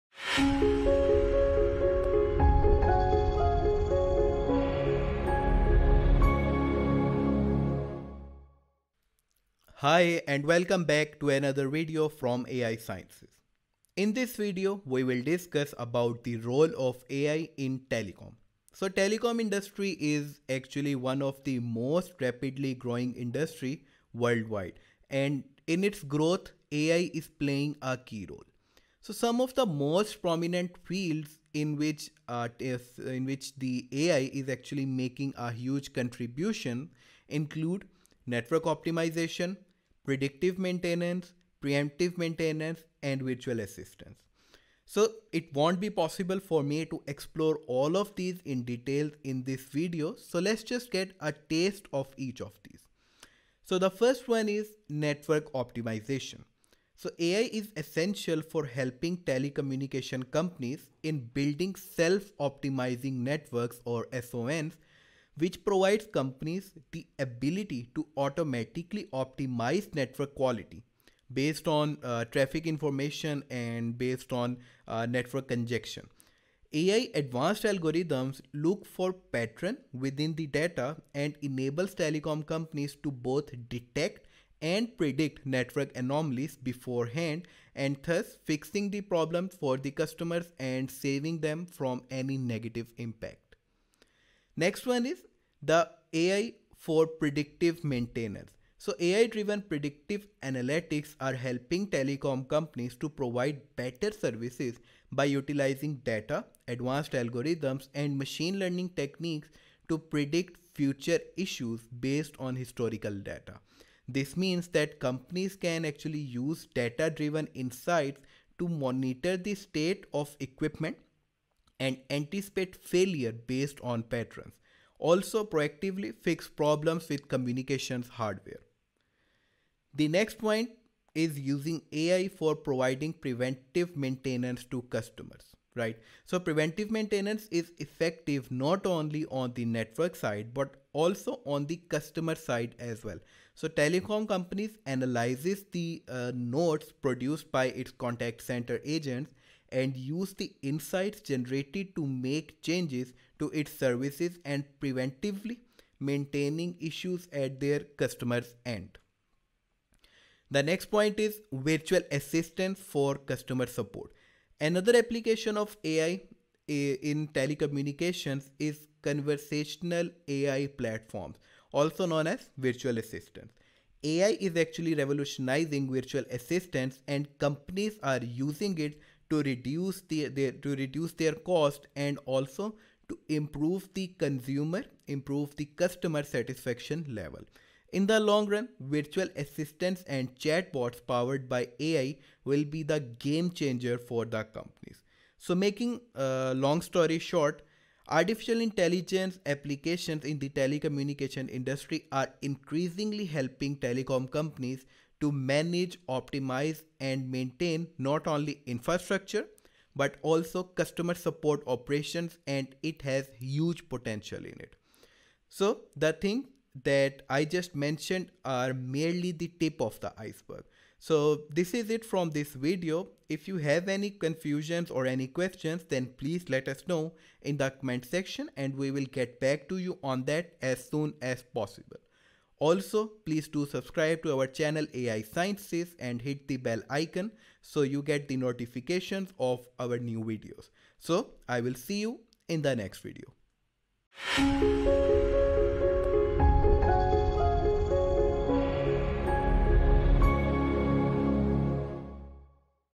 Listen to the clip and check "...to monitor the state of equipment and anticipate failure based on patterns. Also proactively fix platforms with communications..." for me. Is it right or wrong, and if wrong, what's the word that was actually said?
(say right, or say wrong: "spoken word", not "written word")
wrong: "problems", not "platforms".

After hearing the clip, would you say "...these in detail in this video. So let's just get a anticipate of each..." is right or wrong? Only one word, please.
wrong.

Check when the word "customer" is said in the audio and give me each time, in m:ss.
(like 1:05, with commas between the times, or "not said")
1:29, 2:14, 2:21, 2:37, 2:43, 3:05, 3:30.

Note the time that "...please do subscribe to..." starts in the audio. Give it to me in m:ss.
3:53.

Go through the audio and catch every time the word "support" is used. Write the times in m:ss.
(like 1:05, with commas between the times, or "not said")
2:43, 3:31.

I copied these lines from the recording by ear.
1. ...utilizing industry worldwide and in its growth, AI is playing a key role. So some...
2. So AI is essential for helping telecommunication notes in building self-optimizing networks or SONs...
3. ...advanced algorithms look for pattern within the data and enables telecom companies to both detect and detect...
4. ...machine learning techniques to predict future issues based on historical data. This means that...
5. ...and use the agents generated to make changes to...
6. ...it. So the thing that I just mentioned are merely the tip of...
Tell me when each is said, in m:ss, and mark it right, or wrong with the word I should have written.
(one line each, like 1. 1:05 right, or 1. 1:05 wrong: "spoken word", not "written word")
1. 0:22 wrong: "growing", not "utilizing"
2. 0:57 wrong: "companies", not "notes"
3. 1:17 wrong: "predict", not "detect"
4. 1:48 right
5. 2:29 wrong: "insights", not "agents"
6. 3:34 right.